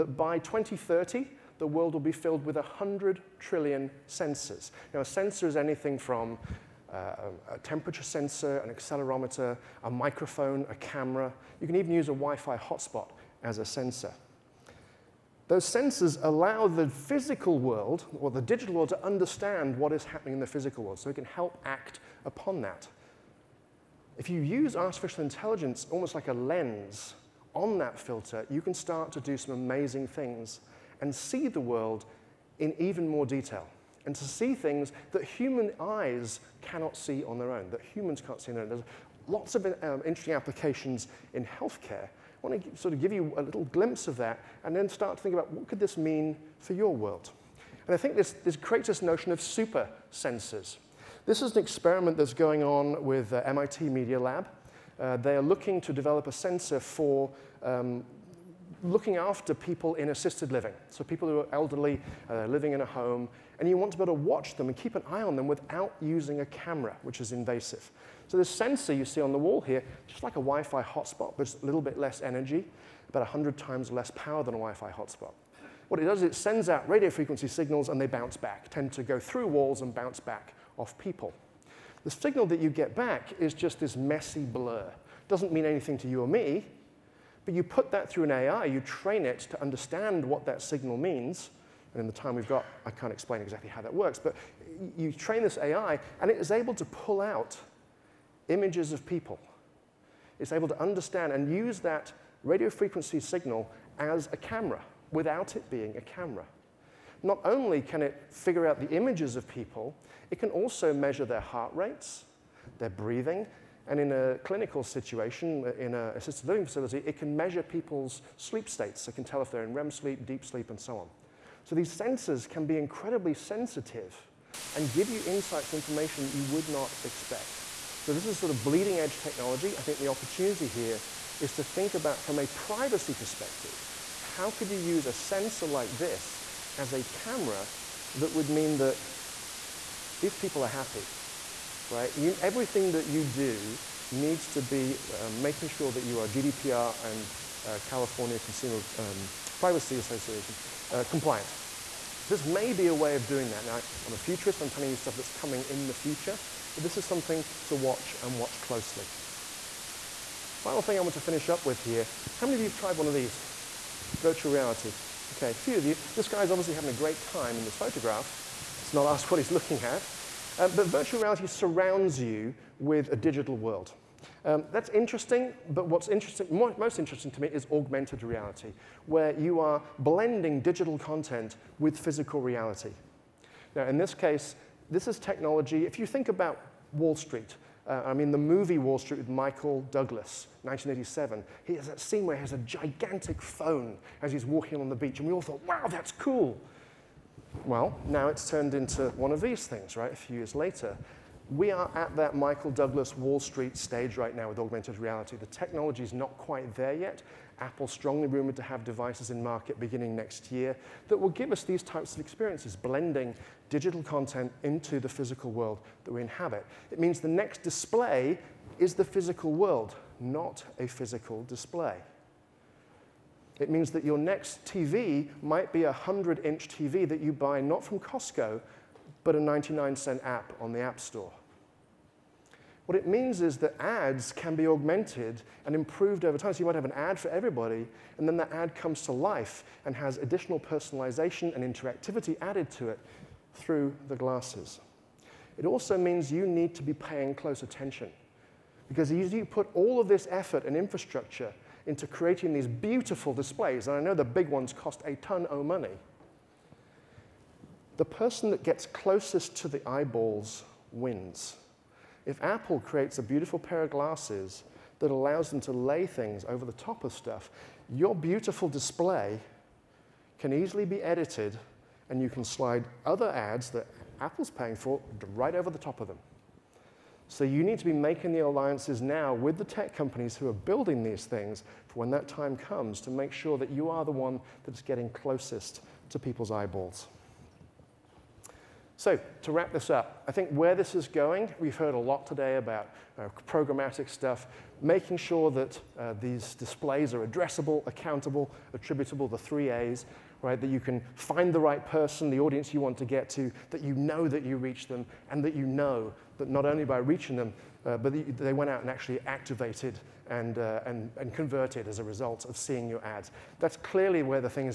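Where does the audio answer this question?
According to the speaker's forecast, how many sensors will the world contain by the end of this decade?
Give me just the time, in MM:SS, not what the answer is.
00:02.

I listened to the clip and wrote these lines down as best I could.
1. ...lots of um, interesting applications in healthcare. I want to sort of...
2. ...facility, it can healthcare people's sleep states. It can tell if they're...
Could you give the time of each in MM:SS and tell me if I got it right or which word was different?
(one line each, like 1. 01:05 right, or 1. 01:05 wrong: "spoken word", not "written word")
1. 00:39 right
2. 01:56 wrong: "measure", not "healthcare".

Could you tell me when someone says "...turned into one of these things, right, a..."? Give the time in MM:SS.
03:18.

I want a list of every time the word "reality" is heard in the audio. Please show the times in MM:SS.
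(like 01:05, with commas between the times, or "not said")
02:44, 02:51, 02:58, 03:02, 03:24.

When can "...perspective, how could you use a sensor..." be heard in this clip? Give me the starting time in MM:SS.
02:13.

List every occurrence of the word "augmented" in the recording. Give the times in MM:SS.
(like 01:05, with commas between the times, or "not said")
02:57, 03:24, 03:54.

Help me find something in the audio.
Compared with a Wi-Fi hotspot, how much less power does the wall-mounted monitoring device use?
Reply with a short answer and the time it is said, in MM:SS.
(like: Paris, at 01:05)
100 times less, at 01:13.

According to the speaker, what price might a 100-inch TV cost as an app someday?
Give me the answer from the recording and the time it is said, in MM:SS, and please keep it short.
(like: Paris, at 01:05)
99 cents, at 03:49.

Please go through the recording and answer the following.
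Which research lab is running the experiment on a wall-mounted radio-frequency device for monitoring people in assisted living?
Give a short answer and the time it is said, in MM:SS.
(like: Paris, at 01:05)
MIT Media Lab, at 00:53.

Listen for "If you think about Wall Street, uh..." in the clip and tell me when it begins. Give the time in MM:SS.
03:05.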